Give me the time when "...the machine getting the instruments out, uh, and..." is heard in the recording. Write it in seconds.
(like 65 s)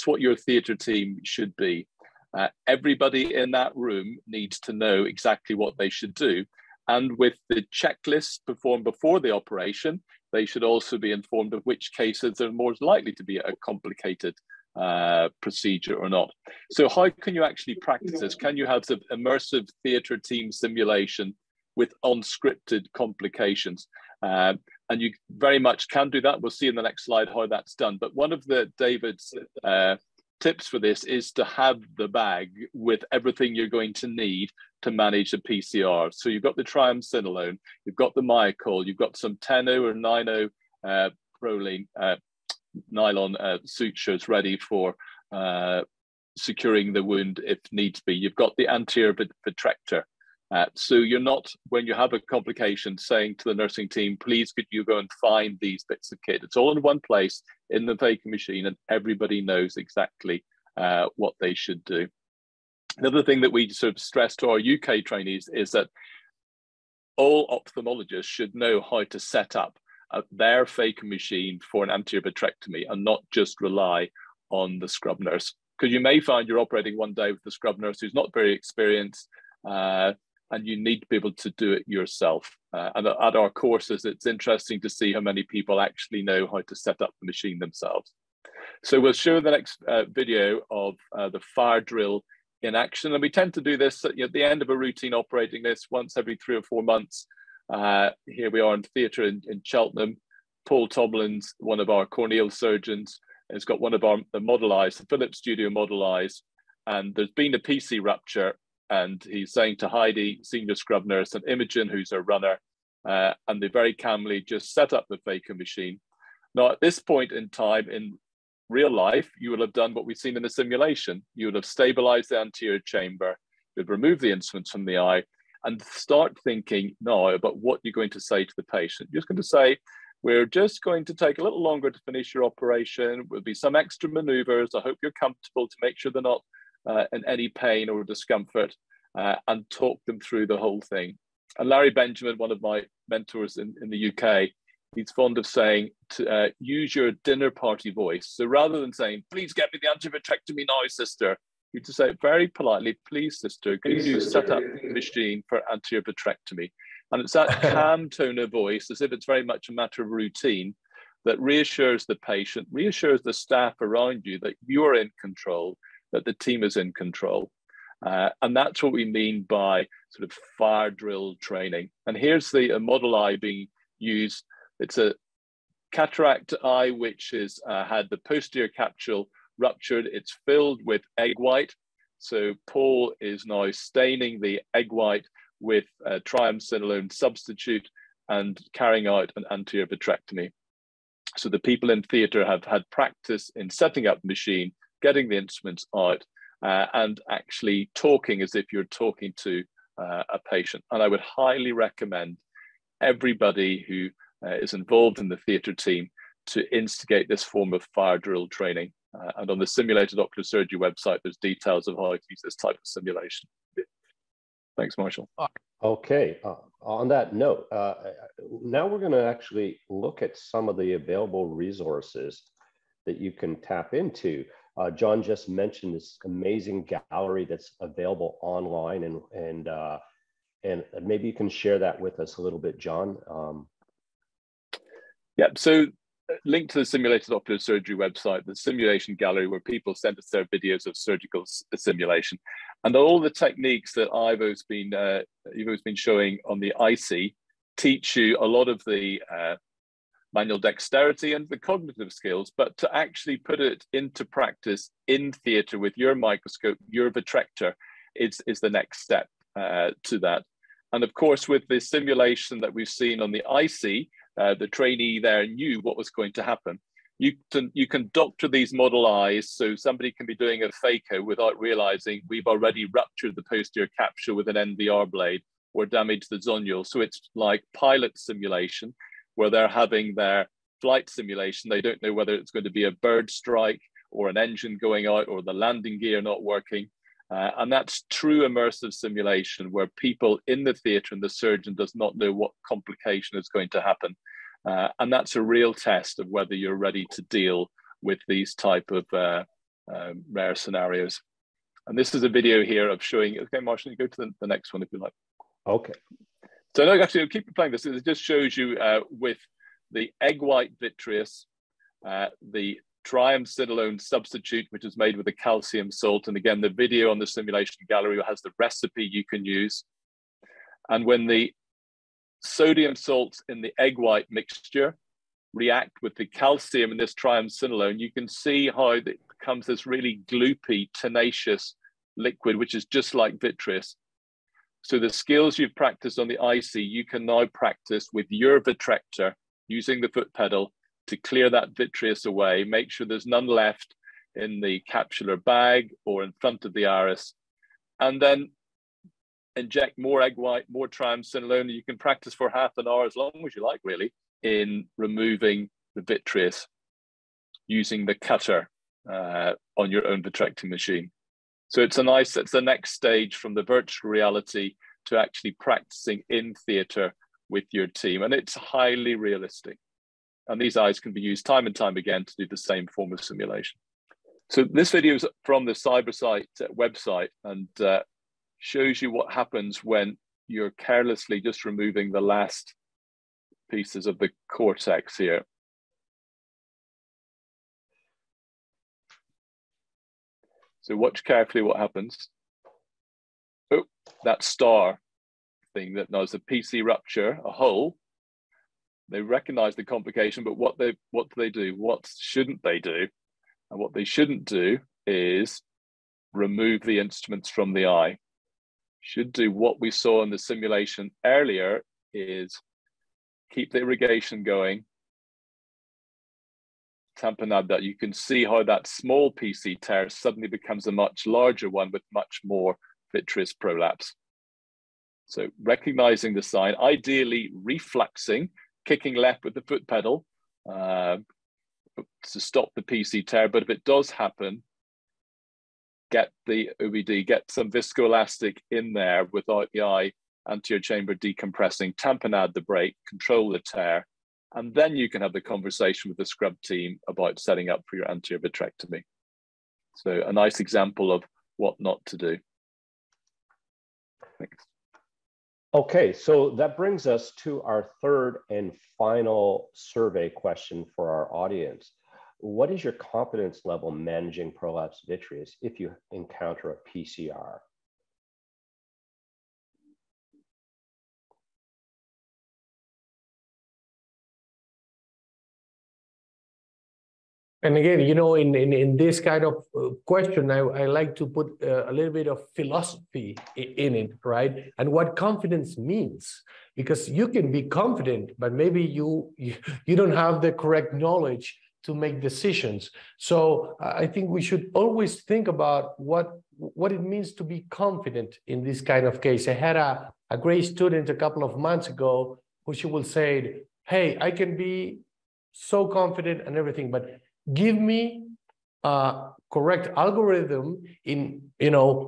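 194 s.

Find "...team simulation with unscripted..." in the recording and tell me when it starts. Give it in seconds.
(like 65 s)
20 s.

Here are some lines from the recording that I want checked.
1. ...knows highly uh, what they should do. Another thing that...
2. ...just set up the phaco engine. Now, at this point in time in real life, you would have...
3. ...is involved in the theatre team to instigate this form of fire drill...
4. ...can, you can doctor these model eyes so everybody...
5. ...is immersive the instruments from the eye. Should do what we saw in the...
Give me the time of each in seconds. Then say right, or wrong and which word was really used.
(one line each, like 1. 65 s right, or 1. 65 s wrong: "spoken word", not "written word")
1. 59 s wrong: "exactly", not "highly"
2. 114 s wrong: "machine", not "engine"
3. 204 s right
4. 267 s wrong: "somebody", not "everybody"
5. 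405 s wrong: "remove", not "immersive".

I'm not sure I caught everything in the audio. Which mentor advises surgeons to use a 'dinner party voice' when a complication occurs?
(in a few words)
Larry Benjamin.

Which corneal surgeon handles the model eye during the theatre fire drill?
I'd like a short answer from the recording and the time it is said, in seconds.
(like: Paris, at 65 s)
Paul Tomlins, at 100 s.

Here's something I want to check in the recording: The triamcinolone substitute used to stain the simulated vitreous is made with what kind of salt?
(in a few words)
Calcium salt.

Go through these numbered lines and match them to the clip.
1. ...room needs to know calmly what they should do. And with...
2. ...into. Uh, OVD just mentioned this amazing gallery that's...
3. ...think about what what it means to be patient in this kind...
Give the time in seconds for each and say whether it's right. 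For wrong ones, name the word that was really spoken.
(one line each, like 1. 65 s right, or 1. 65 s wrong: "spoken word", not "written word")
1. 3 s wrong: "exactly", not "calmly"
2. 223 s wrong: "John", not "OVD"
3. 495 s wrong: "confident", not "patient".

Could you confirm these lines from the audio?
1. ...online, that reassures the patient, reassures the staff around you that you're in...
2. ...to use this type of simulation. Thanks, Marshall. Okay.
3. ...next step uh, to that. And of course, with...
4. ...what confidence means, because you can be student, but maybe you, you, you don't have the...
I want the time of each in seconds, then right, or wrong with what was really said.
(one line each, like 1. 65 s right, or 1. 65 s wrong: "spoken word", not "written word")
1. 160 s wrong: "routine", not "online"
2. 212 s right
3. 258 s right
4. 484 s wrong: "confident", not "student".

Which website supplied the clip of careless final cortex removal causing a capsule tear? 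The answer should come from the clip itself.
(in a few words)
Cybersight.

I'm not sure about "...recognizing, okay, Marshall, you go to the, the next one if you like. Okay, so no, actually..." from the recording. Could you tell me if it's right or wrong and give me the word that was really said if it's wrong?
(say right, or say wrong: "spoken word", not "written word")
wrong: "showing", not "recognizing".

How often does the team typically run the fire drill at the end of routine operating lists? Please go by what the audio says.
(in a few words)
every three or four months.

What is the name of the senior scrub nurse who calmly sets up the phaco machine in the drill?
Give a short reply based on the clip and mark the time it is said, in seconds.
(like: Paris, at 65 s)
Heidi, at 109 s.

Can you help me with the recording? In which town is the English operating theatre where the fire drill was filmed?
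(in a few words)
Cheltenham.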